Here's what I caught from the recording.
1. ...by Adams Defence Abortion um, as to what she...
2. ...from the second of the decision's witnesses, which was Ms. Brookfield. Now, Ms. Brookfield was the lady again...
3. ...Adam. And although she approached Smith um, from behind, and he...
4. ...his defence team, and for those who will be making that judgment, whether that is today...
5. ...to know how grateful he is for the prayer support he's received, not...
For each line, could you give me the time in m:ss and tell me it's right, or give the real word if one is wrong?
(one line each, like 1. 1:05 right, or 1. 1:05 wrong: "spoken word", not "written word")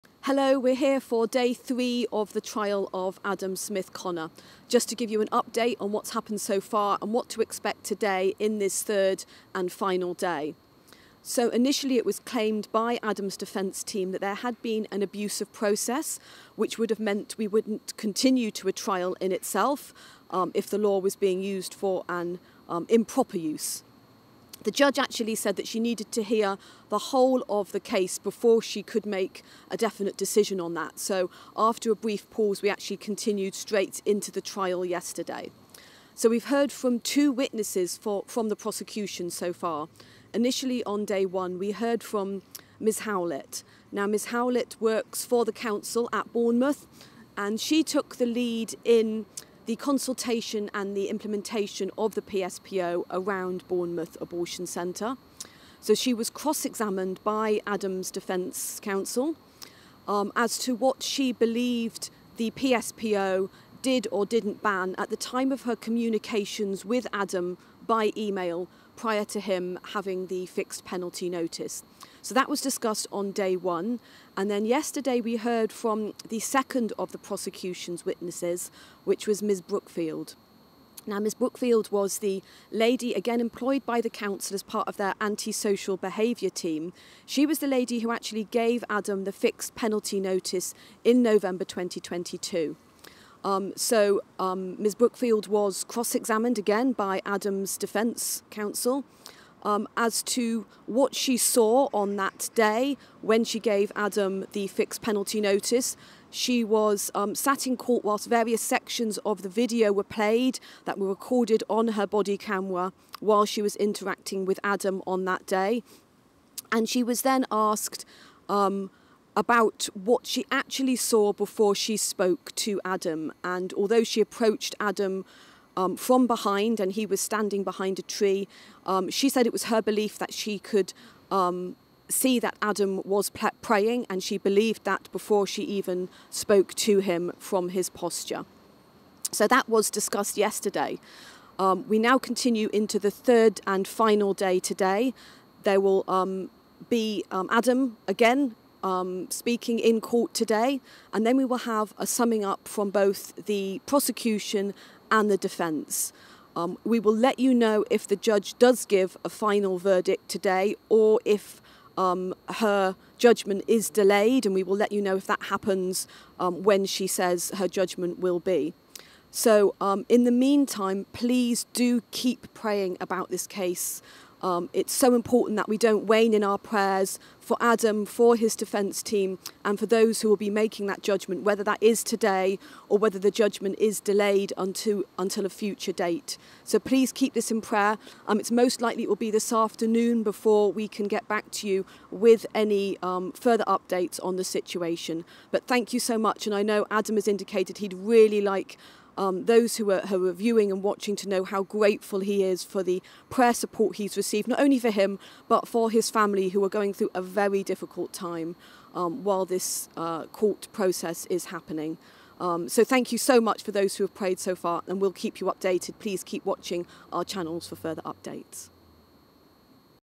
1. 0:57 wrong: "Counsel", not "Abortion"
2. 1:15 wrong: "prosecution", not "decision"
3. 2:02 wrong: "Adam", not "Smith"
4. 2:58 right
5. 3:21 right.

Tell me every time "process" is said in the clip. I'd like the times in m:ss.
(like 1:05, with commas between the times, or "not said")
0:15, 3:30.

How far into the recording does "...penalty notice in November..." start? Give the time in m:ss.
1:29.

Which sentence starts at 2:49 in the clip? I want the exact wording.
So, um, in the meantime, please do keep praying about this case.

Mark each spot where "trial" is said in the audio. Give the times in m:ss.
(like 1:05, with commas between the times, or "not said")
0:02, 0:18, 0:34.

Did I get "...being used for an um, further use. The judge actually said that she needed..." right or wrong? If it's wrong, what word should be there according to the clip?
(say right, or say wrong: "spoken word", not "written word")
wrong: "improper", not "further".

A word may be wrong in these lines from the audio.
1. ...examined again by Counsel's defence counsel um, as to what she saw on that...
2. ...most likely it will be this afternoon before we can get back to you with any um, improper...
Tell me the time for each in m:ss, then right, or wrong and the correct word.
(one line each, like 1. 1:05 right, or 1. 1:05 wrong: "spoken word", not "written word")
1. 1:36 wrong: "Adam", not "Counsel"
2. 3:08 wrong: "further", not "improper".